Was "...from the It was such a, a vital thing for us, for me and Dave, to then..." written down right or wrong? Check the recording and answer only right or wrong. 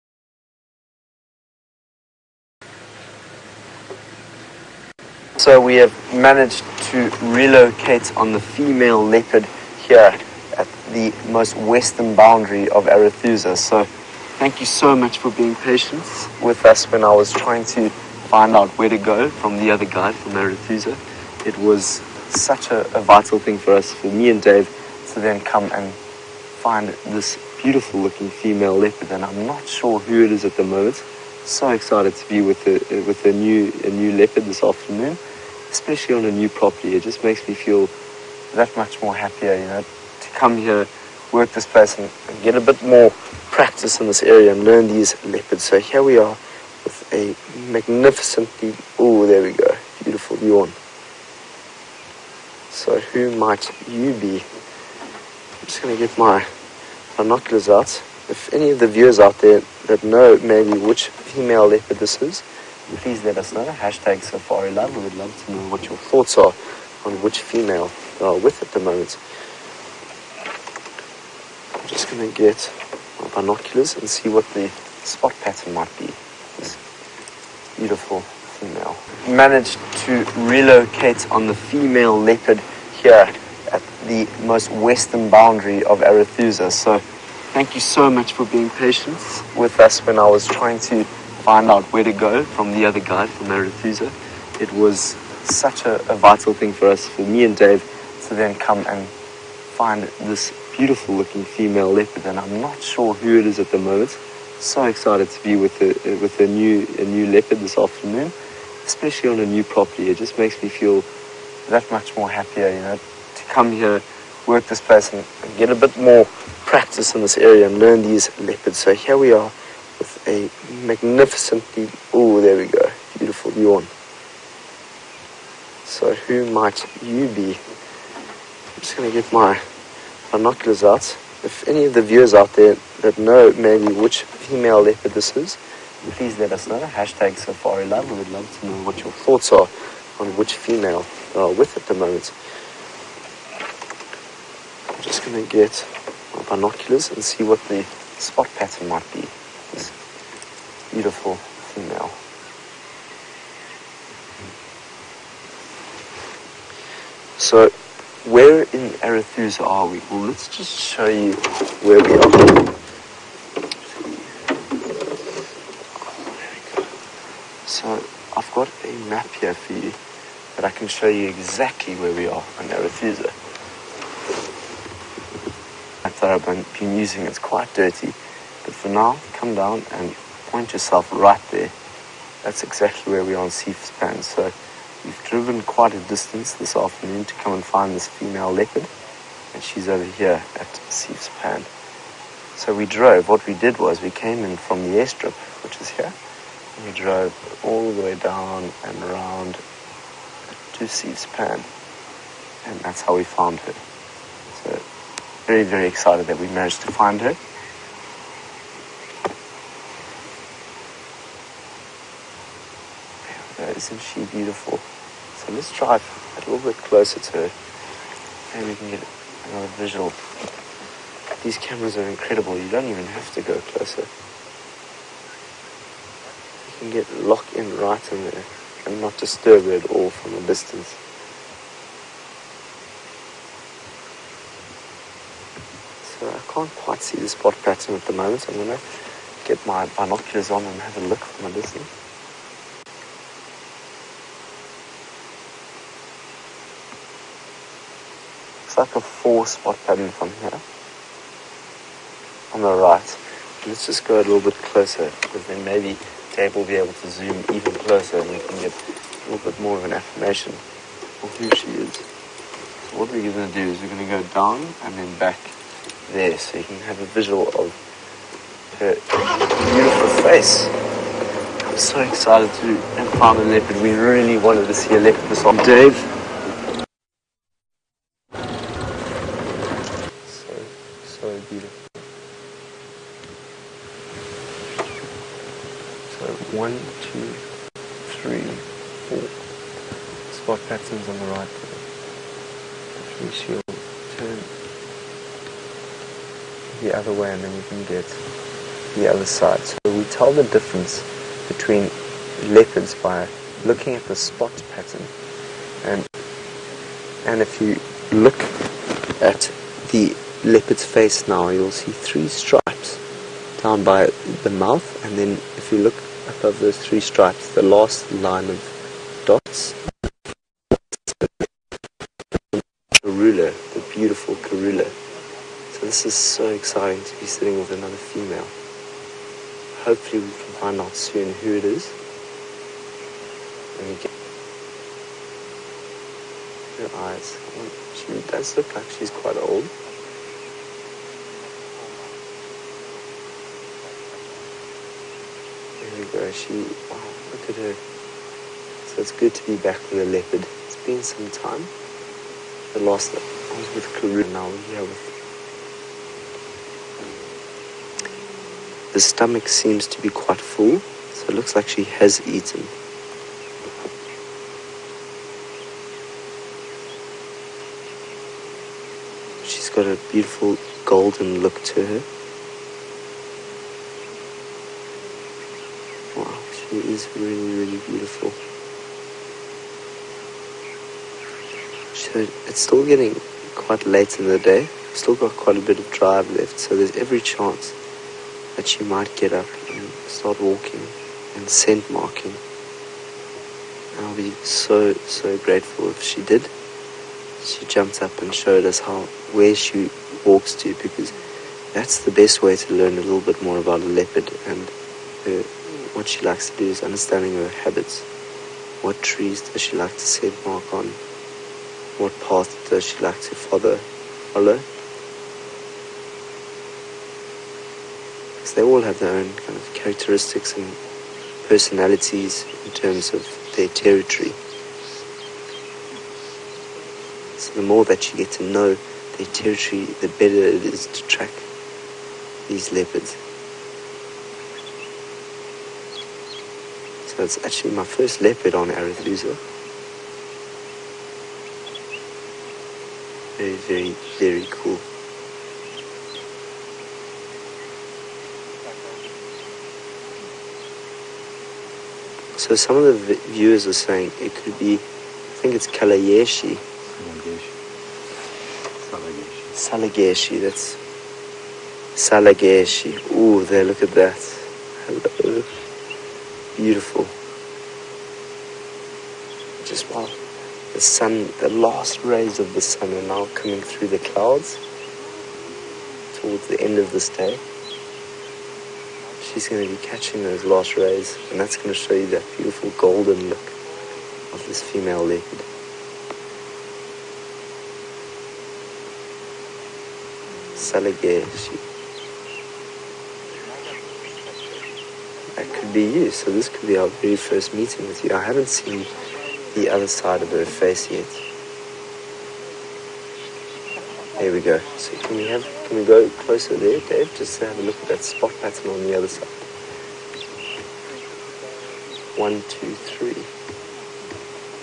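right.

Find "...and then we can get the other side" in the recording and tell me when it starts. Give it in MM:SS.
04:57.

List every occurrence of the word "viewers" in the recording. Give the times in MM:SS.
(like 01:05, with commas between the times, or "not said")
00:58, 02:12, 07:33.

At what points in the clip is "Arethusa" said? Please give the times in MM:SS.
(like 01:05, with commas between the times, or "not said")
00:12, 00:20, 01:26, 02:39, 02:52, 07:18.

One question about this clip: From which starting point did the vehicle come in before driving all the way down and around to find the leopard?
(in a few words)
The airstrip.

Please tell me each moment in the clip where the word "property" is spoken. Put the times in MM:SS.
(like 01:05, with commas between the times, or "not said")
00:36, 01:49.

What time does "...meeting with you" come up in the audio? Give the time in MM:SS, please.
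08:17.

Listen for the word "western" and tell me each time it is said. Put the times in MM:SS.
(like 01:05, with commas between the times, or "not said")
00:11, 01:24.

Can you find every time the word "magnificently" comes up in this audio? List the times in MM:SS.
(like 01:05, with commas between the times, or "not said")
00:47, 02:00.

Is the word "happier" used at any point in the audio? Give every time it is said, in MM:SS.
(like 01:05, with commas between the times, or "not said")
00:39, 01:52.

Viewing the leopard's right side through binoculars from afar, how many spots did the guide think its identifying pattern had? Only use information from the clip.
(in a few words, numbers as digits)
4.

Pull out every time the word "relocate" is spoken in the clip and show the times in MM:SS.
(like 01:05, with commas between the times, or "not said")
00:07, 01:20.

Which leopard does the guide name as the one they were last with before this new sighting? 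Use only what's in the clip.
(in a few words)
Karula.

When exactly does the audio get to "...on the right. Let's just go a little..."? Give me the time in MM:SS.
04:12.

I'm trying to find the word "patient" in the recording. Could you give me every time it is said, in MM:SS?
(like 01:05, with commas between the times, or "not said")
00:15, 01:28.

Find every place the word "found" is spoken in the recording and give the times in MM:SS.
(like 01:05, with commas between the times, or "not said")
03:23, 04:33.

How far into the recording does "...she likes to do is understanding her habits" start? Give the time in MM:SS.
06:46.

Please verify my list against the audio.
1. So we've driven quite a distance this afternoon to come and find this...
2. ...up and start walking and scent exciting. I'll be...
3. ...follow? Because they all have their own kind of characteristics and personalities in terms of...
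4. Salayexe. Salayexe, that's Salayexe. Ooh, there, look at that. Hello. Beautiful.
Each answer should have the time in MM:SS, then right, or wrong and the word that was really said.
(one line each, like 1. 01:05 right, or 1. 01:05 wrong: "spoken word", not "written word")
1. 03:04 right
2. 06:29 wrong: "marking", not "exciting"
3. 06:53 right
4. 07:38 right.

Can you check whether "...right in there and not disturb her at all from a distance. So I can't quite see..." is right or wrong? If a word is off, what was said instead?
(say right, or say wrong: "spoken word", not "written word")
right.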